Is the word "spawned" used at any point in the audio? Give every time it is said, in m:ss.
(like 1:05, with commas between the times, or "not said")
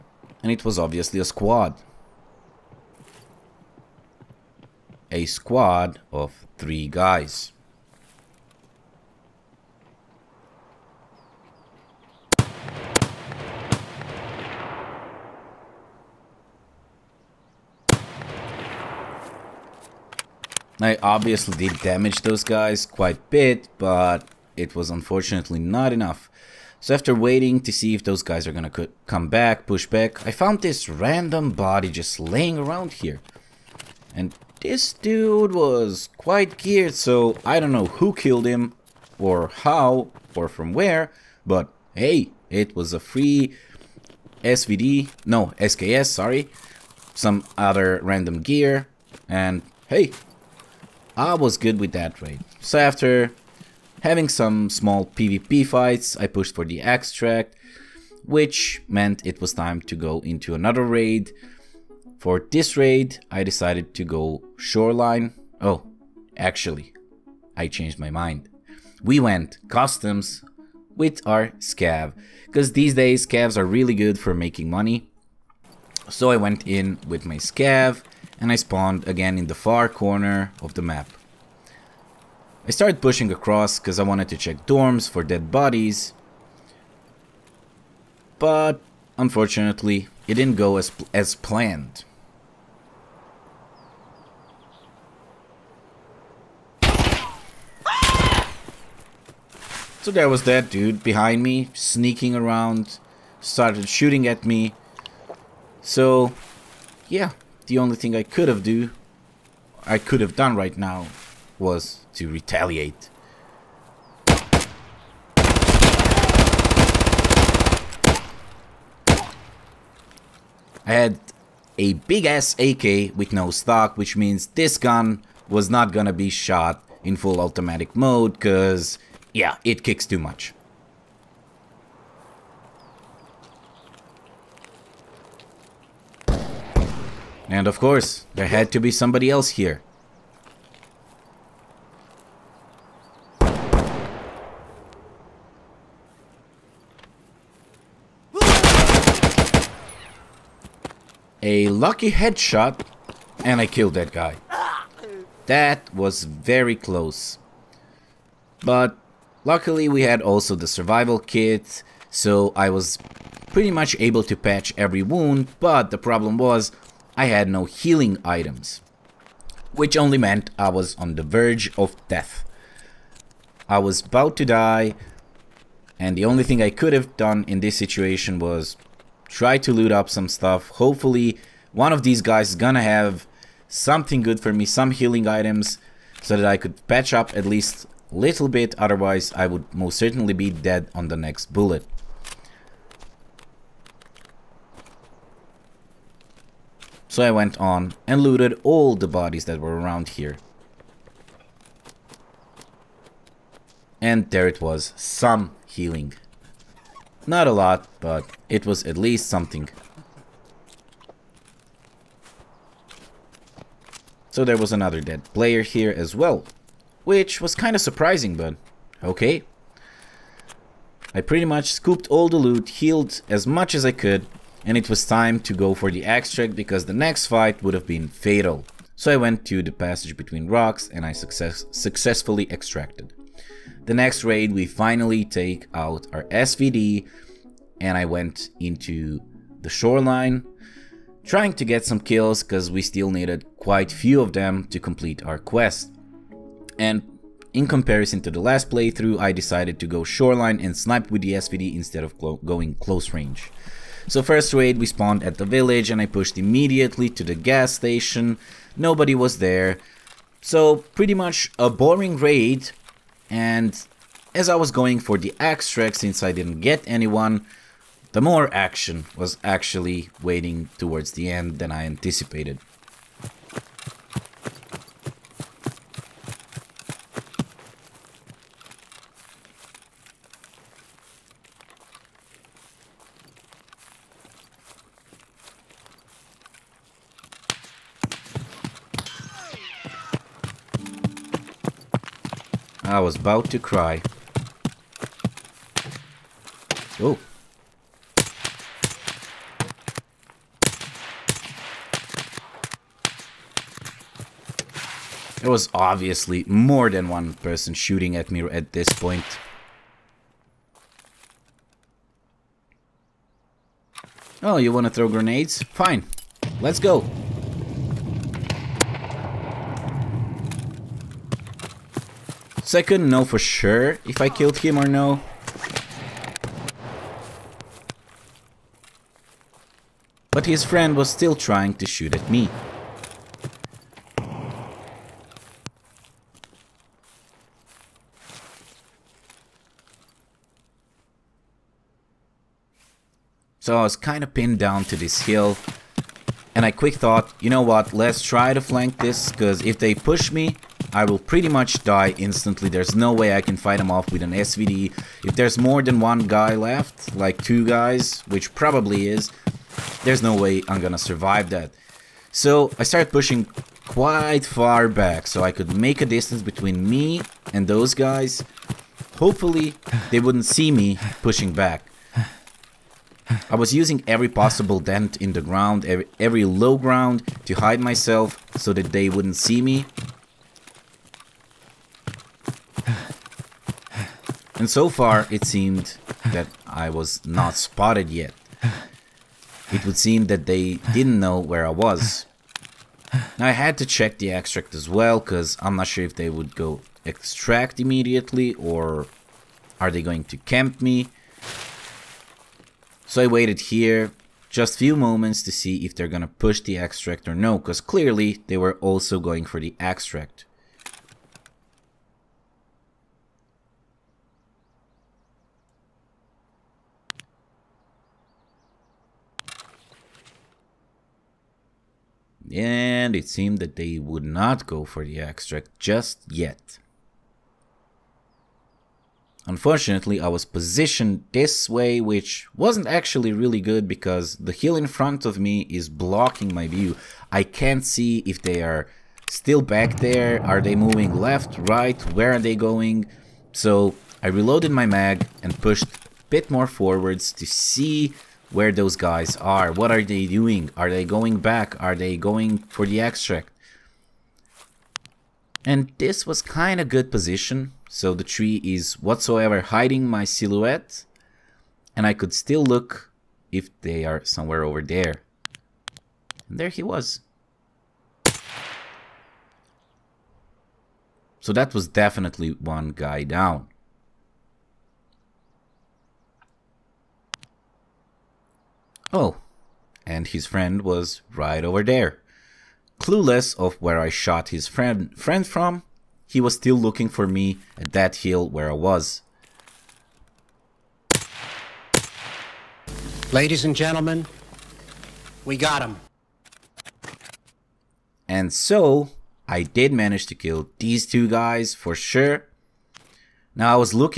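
1:18, 4:14.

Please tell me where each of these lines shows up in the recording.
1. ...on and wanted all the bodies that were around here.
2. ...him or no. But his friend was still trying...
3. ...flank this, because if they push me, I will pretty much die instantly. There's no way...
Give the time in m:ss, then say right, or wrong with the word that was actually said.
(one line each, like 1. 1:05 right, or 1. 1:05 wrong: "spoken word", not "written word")
1. 3:17 wrong: "looted", not "wanted"
2. 5:24 right
3. 5:48 right.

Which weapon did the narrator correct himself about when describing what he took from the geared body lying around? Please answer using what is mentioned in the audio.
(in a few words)
SKS.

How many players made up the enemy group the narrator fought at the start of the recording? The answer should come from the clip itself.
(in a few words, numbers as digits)
3.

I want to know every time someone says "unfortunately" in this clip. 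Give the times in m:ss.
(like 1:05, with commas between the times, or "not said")
0:24, 1:29, 7:09.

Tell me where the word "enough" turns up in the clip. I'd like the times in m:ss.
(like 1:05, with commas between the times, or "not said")
0:25.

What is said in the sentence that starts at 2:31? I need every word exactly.
A lucky headshot, and I killed that guy.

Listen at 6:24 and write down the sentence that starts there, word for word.
And so far, it seemed that I was not spotted yet.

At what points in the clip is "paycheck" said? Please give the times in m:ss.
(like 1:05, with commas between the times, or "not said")
not said.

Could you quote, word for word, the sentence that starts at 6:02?
So I started pushing quite far back so I could make a distance between me and those guys.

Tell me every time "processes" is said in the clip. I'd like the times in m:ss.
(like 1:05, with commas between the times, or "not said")
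not said.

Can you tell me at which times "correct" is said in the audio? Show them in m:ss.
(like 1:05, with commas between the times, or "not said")
not said.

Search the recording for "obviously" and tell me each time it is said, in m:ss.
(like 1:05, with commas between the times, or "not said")
0:00, 0:21, 5:05.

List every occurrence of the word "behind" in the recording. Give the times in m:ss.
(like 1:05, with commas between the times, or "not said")
1:41.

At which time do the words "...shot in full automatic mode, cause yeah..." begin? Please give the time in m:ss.
2:06.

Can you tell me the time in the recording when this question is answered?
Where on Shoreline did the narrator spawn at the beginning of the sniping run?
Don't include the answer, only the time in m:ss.
4:15.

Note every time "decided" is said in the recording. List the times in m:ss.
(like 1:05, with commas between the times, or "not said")
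1:03, 4:09.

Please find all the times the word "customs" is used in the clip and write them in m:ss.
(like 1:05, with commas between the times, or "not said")
1:09.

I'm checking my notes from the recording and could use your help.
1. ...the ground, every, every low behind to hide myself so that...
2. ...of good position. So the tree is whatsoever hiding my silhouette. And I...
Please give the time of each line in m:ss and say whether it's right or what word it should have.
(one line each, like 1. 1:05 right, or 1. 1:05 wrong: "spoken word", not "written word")
1. 6:15 wrong: "ground", not "behind"
2. 7:36 right.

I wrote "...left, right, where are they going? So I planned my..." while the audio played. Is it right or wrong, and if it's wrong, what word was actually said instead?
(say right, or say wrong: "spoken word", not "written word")
wrong: "reloaded", not "planned".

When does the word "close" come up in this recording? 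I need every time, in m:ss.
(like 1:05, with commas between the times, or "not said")
2:36, 4:12.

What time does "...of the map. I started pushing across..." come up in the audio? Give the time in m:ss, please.
1:20.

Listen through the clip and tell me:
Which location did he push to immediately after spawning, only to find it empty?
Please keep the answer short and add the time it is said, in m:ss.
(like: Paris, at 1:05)
Gas station, at 4:17.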